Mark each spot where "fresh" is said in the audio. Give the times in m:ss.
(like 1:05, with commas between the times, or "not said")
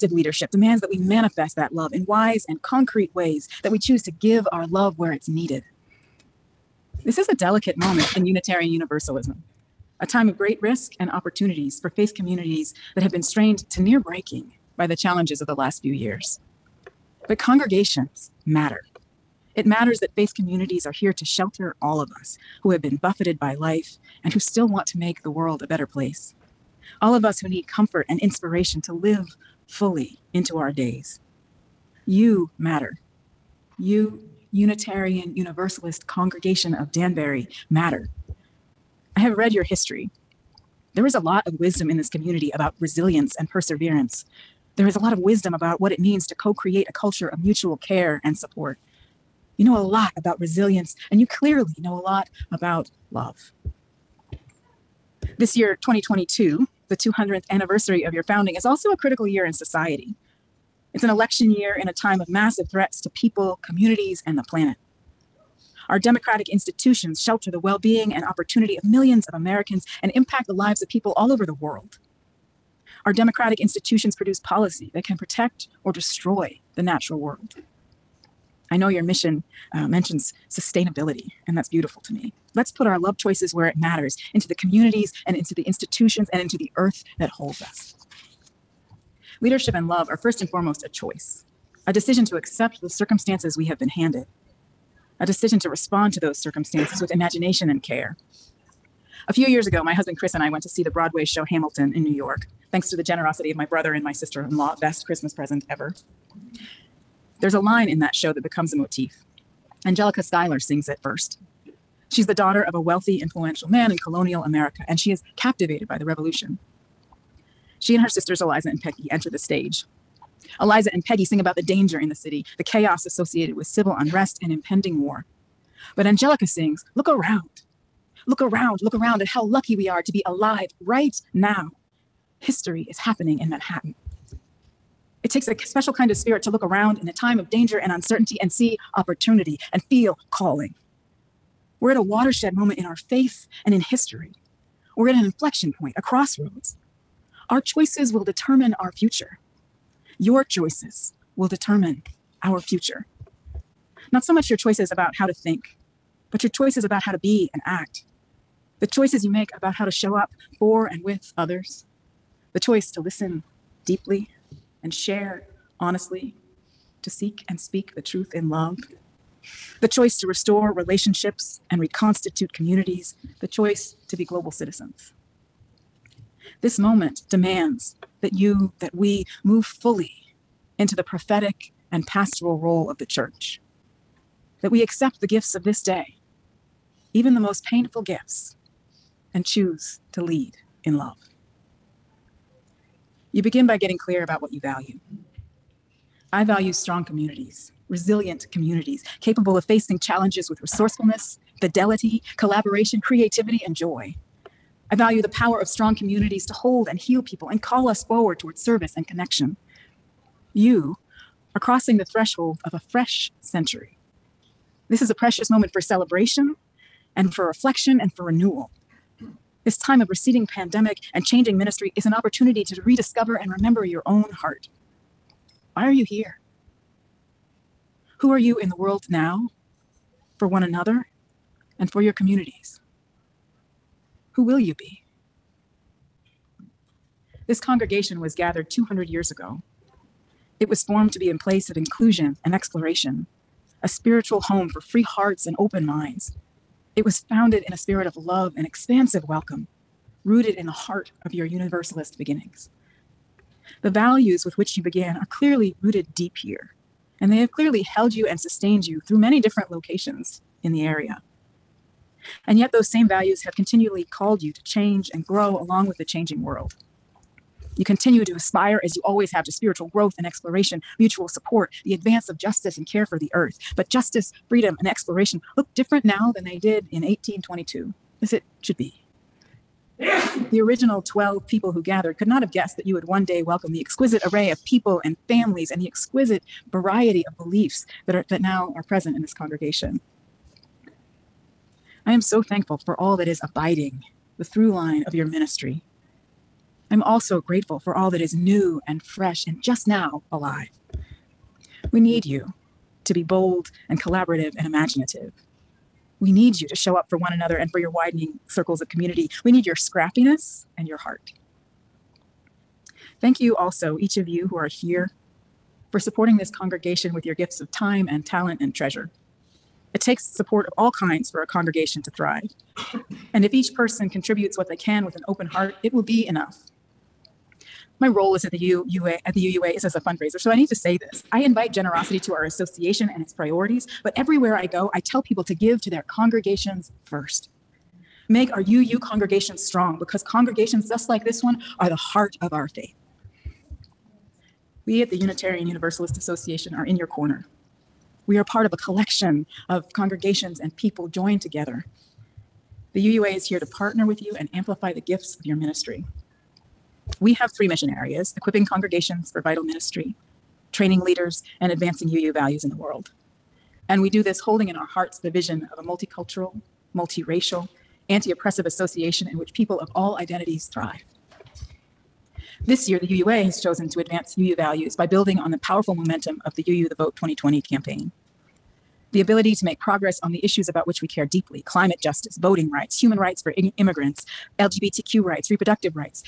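3:32, 4:59.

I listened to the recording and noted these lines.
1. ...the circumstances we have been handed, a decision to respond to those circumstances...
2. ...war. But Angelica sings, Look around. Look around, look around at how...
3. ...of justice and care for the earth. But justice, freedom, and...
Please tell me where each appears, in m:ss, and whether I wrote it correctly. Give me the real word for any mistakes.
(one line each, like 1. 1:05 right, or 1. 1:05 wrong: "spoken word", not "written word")
1. 1:32 right
2. 2:05 right
3. 4:32 right.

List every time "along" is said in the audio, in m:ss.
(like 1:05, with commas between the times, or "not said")
4:25.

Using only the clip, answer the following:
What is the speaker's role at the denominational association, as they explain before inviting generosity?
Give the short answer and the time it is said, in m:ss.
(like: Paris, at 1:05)
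fundraiser, at 5:29.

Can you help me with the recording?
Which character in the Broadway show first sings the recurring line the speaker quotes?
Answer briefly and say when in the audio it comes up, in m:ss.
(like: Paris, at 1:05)
Angelica Schuyler, at 1:49.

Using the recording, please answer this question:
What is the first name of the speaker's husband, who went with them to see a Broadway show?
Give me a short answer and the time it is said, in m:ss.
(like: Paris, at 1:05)
Chris, at 1:40.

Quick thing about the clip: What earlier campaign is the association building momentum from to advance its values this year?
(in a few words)
UU the Vote 2020.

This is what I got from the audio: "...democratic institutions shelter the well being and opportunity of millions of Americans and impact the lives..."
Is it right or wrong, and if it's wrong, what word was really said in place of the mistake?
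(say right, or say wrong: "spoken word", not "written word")
right.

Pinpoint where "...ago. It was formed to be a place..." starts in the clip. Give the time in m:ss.
3:59.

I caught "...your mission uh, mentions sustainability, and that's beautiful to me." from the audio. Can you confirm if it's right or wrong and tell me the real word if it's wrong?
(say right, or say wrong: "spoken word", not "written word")
right.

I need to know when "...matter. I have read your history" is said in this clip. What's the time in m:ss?
0:37.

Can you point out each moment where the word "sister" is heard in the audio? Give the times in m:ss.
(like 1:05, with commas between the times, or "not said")
1:44, 1:58.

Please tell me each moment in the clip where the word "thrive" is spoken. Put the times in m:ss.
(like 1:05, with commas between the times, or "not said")
5:22, 6:10.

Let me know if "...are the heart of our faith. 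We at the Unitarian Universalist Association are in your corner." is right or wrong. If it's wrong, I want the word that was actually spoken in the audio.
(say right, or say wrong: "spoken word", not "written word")
right.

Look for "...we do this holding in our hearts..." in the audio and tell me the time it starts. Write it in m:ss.
6:04.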